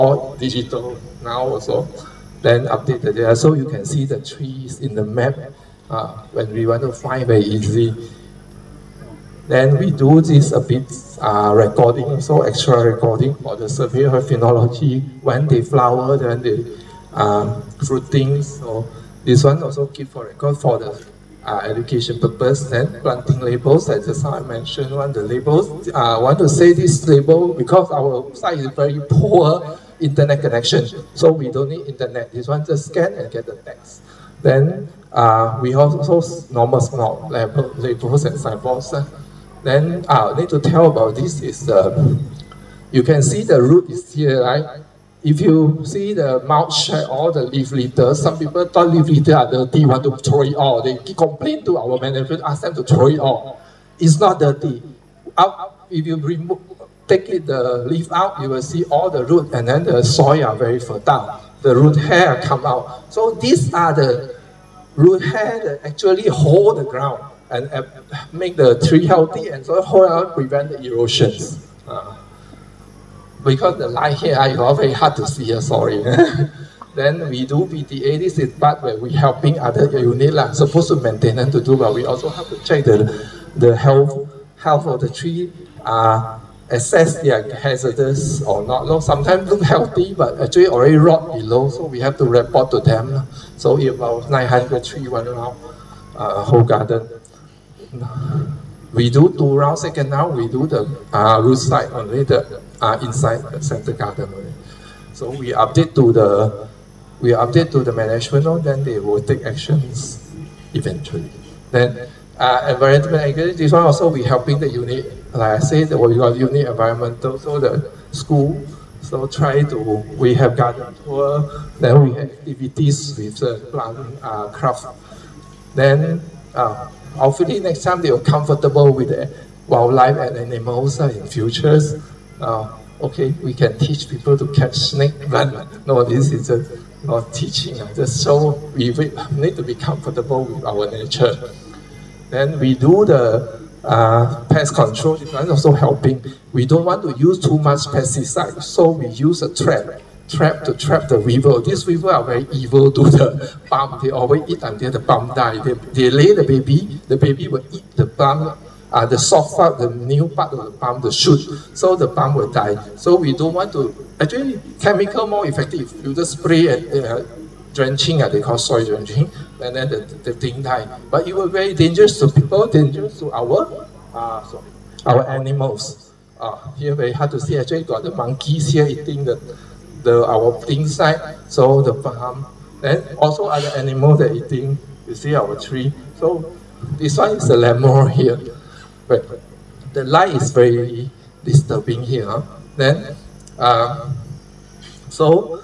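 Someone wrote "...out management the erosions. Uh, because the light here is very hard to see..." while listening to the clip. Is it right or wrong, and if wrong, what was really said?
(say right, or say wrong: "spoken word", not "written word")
wrong: "prevent", not "management".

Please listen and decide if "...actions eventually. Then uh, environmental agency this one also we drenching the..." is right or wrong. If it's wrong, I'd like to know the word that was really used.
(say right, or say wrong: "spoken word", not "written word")
wrong: "helping", not "drenching".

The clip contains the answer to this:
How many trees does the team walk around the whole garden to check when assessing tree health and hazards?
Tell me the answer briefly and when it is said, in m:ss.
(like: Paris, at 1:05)
900, at 1:34.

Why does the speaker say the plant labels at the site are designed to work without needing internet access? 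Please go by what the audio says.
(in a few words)
poor internet connection.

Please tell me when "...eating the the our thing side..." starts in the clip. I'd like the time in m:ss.
2:58.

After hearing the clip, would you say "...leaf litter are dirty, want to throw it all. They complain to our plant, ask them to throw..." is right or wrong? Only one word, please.
wrong.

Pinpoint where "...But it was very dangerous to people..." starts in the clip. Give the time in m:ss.
2:51.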